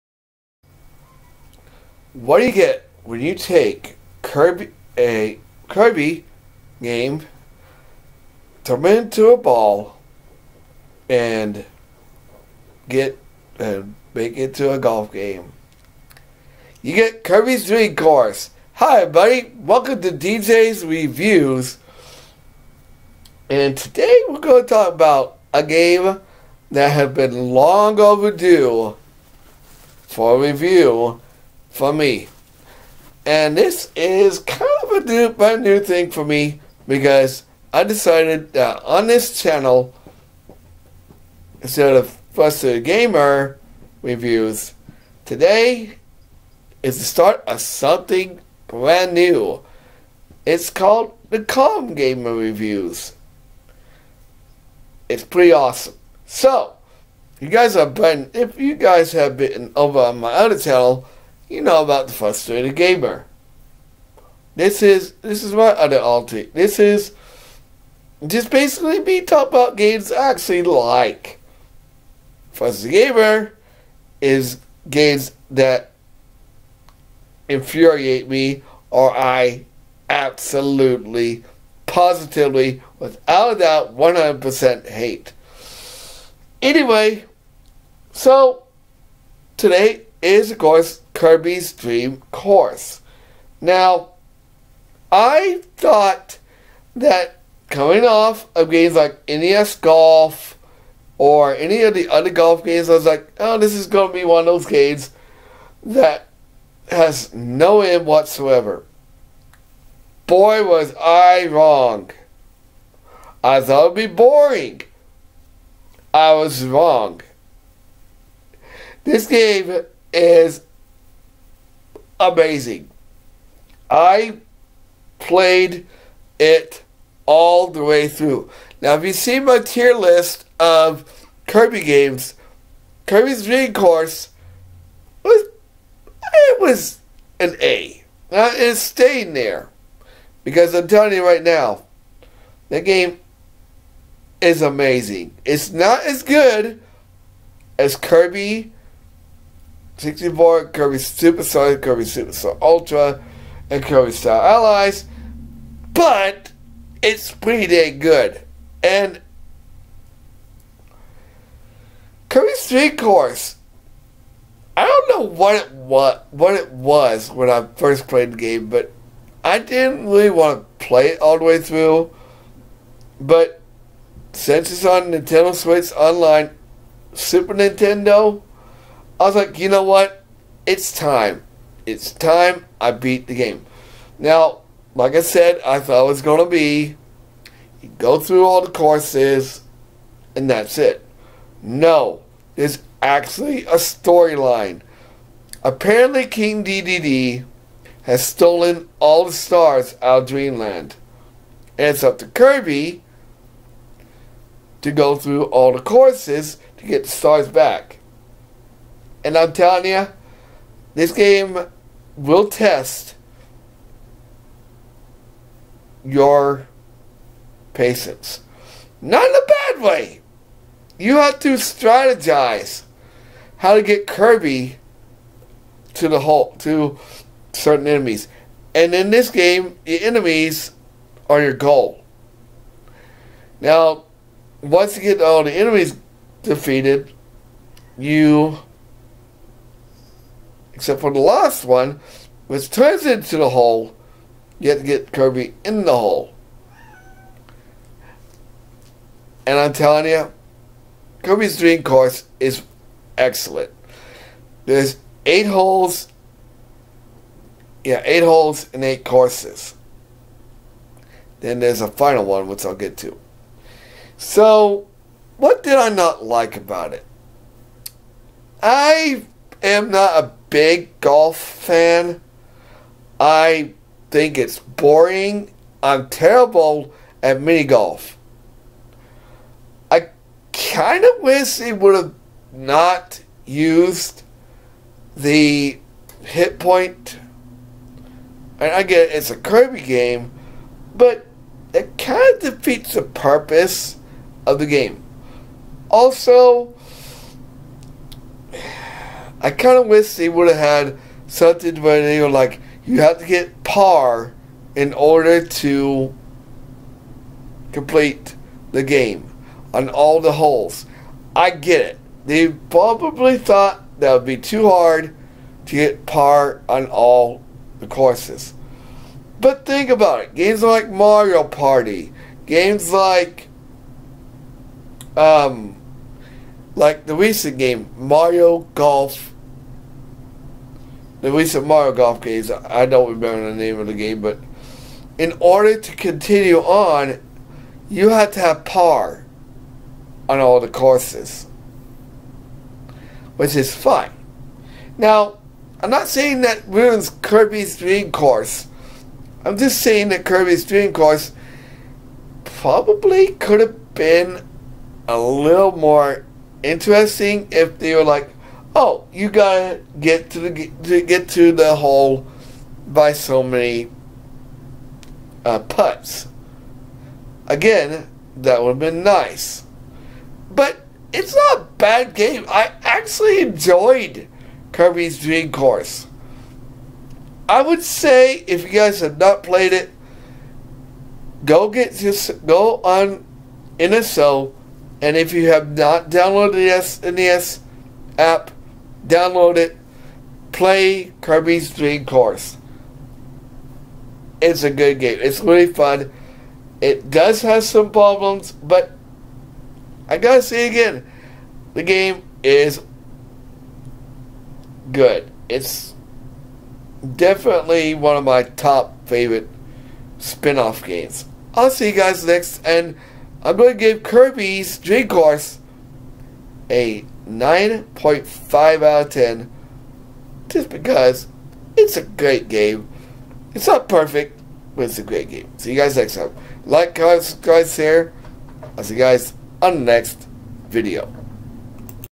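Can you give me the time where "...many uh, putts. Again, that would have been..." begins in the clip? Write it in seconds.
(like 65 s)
363 s.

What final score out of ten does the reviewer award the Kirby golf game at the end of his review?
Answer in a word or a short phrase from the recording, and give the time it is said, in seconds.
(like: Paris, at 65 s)
9.5, at 417 s.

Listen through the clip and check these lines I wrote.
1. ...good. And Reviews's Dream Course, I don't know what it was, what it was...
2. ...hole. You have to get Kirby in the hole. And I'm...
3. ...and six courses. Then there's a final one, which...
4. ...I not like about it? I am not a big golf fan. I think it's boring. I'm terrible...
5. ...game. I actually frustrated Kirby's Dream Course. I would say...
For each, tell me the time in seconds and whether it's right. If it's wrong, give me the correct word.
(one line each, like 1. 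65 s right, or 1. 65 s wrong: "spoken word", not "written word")
1. 157 s wrong: "Kirby", not "Reviews"
2. 243 s right
3. 258 s wrong: "eight", not "six"
4. 265 s right
5. 372 s wrong: "enjoyed", not "frustrated".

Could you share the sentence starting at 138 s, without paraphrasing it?
Now, it's staying there because I'm telling you right now, that game is amazing.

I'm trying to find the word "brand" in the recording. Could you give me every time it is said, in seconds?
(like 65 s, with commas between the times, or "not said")
35 s, 48 s.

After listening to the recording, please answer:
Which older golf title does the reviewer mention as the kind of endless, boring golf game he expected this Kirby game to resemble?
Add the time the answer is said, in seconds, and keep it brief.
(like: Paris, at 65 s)
NES Golf, at 99 s.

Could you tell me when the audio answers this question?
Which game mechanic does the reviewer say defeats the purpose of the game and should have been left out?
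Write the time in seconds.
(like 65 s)
285 s.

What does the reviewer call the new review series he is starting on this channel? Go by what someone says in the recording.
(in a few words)
Calm Gamer Reviews.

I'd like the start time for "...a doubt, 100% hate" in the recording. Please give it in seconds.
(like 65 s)
83 s.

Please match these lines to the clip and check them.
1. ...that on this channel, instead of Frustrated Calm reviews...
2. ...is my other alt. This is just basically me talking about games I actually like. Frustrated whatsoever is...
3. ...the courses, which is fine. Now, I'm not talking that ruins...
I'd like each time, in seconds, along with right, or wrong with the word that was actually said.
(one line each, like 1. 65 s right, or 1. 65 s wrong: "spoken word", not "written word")
1. 38 s wrong: "Gamer", not "Calm"
2. 65 s wrong: "gamer", not "whatsoever"
3. 340 s wrong: "saying", not "talking".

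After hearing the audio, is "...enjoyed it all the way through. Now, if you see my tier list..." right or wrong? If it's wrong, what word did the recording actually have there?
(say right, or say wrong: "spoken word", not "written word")
wrong: "played", not "enjoyed".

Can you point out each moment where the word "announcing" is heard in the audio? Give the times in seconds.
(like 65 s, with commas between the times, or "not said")
not said.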